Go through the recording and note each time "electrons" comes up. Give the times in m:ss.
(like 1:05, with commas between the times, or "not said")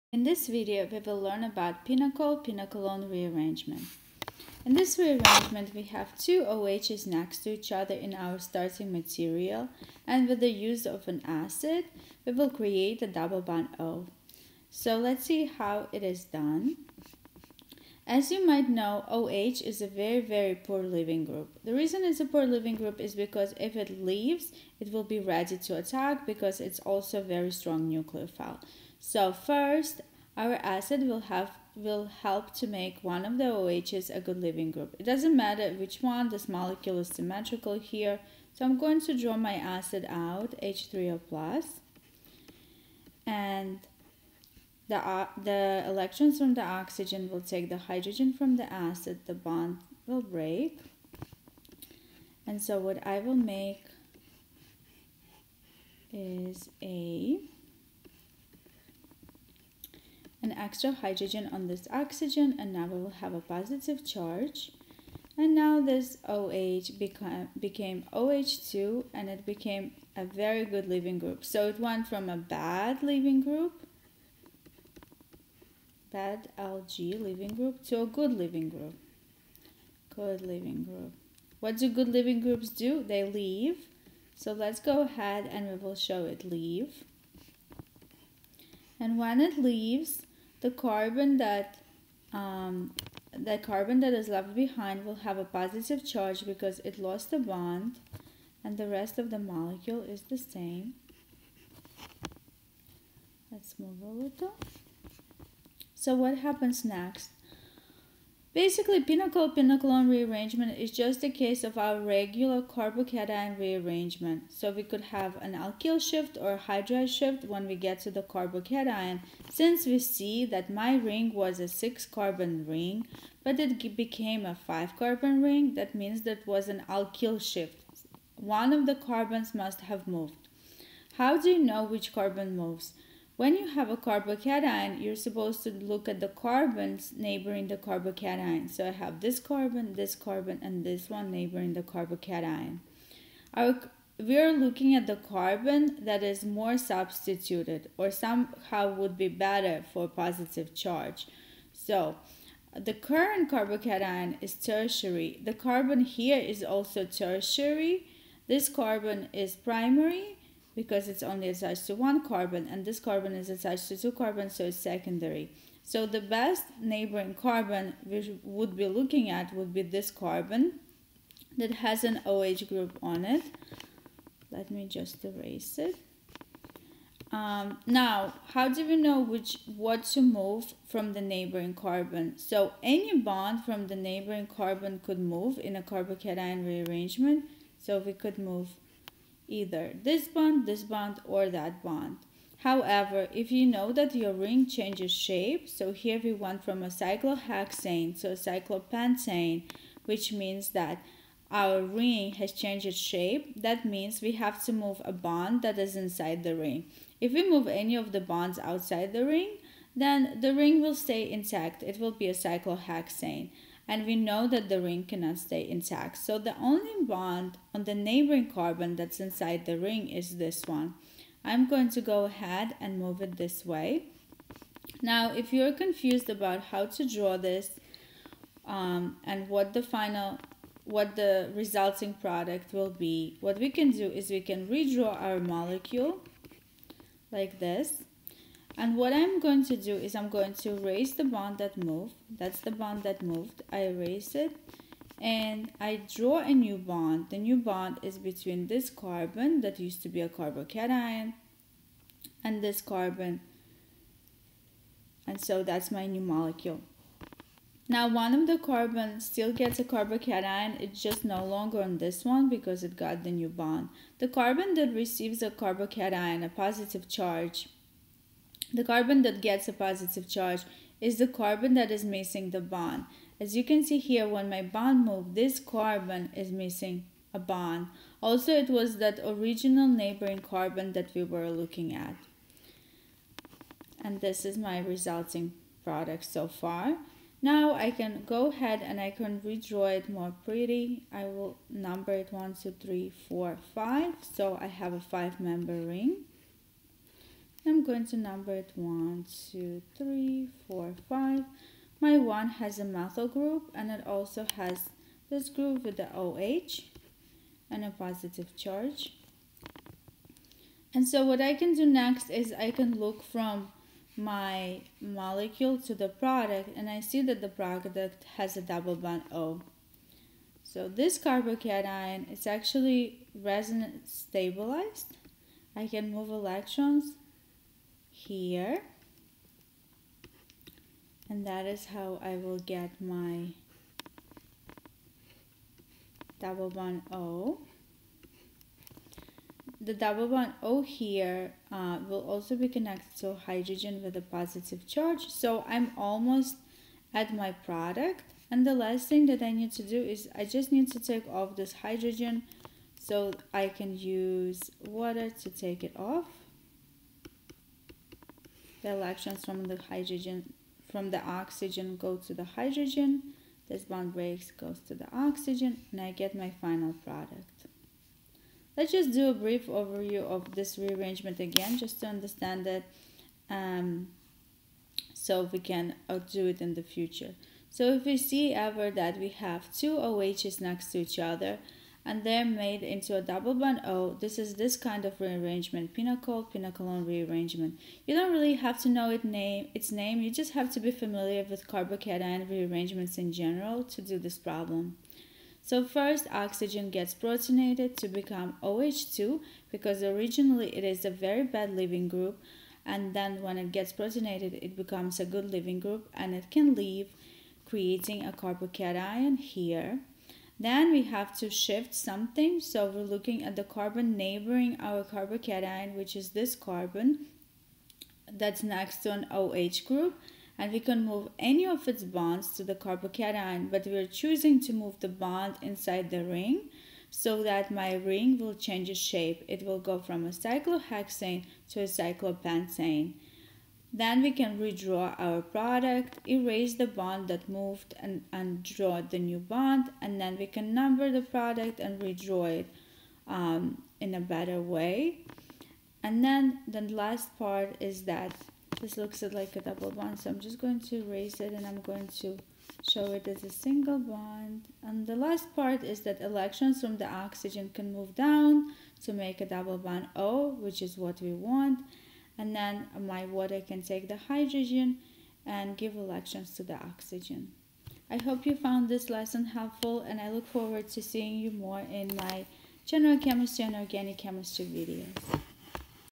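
0:45, 5:26, 5:58, 7:36, 7:45.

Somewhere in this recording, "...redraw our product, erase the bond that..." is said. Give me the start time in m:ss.
7:14.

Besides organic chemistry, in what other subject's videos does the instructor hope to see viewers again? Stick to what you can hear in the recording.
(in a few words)
general chemistry.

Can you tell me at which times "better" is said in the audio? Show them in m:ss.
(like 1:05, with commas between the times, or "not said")
2:29, 7:24.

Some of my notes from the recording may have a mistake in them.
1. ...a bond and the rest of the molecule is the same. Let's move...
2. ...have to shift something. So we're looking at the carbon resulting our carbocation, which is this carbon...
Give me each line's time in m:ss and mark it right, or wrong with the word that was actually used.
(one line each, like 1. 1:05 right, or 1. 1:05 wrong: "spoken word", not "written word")
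1. 1:37 right
2. 6:51 wrong: "neighboring", not "resulting".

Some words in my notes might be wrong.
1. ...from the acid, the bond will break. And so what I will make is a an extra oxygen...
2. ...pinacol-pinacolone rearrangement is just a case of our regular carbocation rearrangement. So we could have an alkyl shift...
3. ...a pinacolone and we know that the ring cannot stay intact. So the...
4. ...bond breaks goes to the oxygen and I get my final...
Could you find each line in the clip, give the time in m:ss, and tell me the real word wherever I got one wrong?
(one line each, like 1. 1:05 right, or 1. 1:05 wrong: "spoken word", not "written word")
1. 0:48 wrong: "hydrogen", not "oxygen"
2. 1:49 right
3. 3:32 wrong: "cyclohexane", not "pinacolone"
4. 6:03 right.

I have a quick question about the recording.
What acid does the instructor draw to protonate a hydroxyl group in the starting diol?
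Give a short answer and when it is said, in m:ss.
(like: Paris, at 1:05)
H3O+, at 0:40.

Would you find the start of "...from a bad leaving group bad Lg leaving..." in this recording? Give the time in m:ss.
1:12.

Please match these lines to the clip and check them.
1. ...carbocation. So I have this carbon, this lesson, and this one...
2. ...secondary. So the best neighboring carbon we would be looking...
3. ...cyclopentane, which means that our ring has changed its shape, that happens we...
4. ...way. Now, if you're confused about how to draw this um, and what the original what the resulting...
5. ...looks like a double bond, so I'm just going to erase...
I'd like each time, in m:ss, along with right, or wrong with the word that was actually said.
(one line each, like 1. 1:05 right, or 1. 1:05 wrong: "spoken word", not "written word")
1. 2:17 wrong: "carbon", not "lesson"
2. 2:44 right
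3. 3:18 wrong: "means", not "happens"
4. 3:43 wrong: "final", not "original"
5. 7:28 right.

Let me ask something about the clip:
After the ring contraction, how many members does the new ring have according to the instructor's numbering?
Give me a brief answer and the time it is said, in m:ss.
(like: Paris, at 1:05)
5, at 4:55.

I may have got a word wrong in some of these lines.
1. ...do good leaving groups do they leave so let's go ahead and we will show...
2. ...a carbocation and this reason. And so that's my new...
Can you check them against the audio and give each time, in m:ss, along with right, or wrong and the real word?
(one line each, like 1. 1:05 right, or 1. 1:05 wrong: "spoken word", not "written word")
1. 1:21 right
2. 4:10 wrong: "carbon", not "reason".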